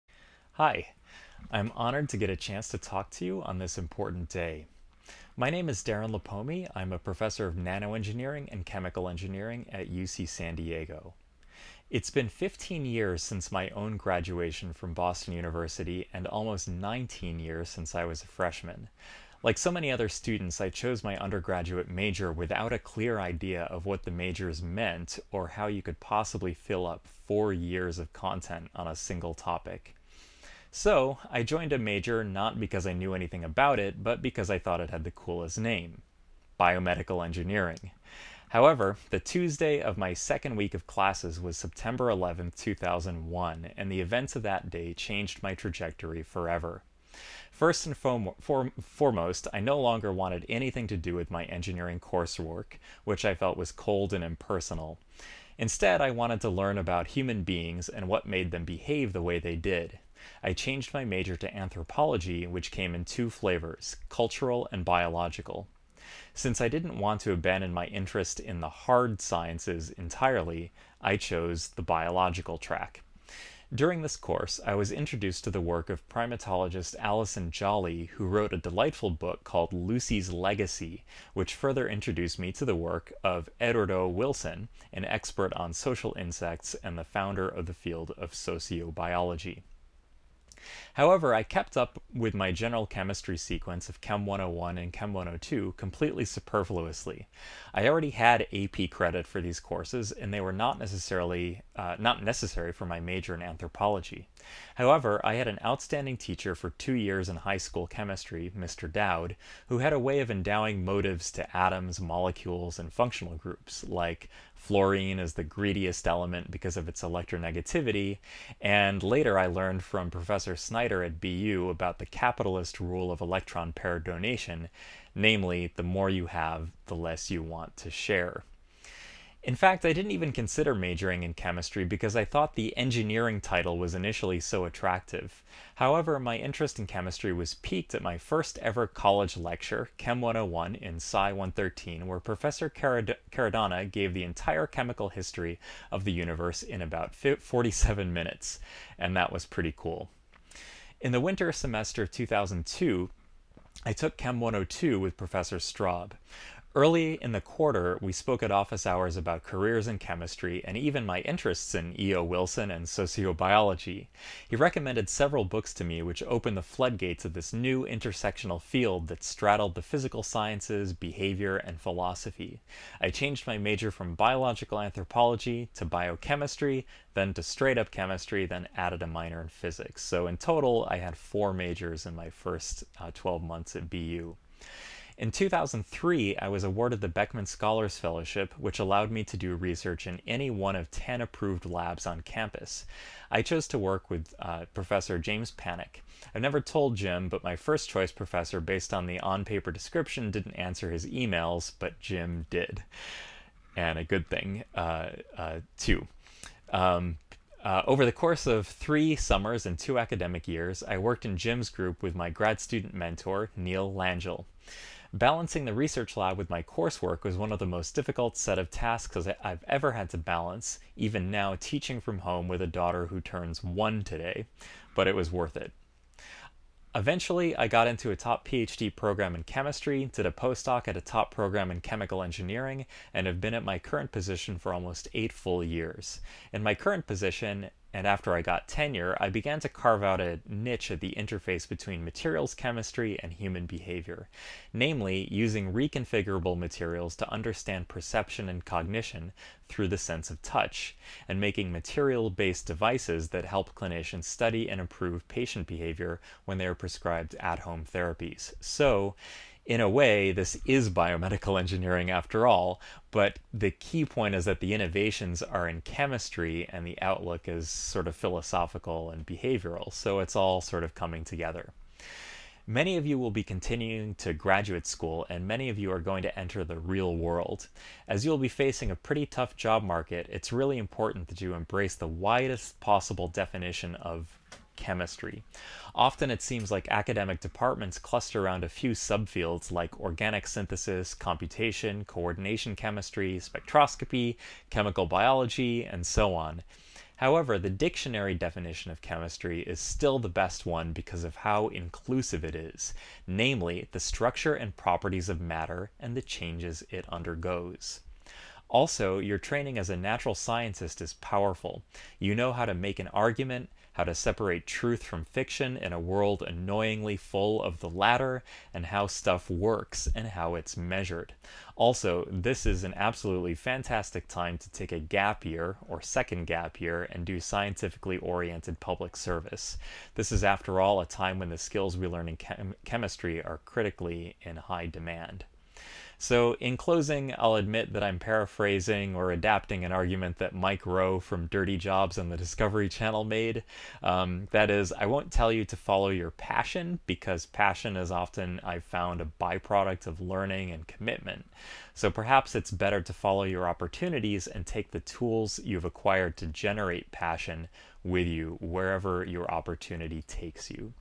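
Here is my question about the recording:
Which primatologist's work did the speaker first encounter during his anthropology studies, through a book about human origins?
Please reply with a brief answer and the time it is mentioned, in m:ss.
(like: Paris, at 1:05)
Alison Jolly, at 1:16.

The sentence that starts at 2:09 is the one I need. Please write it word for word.
In fact, I didn't even consider majoring in chemistry because I thought the engineering title was initially so attractive.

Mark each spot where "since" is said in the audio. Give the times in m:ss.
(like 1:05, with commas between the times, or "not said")
0:13, 0:17, 1:06.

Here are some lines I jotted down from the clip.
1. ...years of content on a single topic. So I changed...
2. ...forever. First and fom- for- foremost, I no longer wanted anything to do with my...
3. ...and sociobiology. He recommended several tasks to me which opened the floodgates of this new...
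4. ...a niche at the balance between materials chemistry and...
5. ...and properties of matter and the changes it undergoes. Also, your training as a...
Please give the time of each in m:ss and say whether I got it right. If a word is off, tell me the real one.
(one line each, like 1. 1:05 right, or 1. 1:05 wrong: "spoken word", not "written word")
1. 0:27 wrong: "joined", not "changed"
2. 0:46 right
3. 2:42 wrong: "books", not "tasks"
4. 4:00 wrong: "interface", not "balance"
5. 5:04 right.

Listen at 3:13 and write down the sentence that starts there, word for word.
I chose to work with uh, Professor James Panek.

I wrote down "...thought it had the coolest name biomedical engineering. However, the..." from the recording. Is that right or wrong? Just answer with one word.
right.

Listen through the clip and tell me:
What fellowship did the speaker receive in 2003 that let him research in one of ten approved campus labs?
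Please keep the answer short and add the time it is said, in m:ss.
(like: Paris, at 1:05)
Beckman Scholars Fellowship, at 3:07.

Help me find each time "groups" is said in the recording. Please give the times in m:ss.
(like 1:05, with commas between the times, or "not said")
1:53, 3:31.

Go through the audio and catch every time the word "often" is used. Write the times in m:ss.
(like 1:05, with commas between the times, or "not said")
4:45, 5:48.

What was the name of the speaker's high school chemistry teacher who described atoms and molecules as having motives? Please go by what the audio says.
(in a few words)
Mr. Dowd.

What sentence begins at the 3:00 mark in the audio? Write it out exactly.
So in total, I had four majors in my first uh, 12 months at BU.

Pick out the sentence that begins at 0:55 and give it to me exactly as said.
Instead, I wanted to learn about human beings and what made them behave the way they did.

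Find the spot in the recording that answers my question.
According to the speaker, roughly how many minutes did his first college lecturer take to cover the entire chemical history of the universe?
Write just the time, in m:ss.
2:27.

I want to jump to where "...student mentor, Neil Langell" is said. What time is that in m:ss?
3:32.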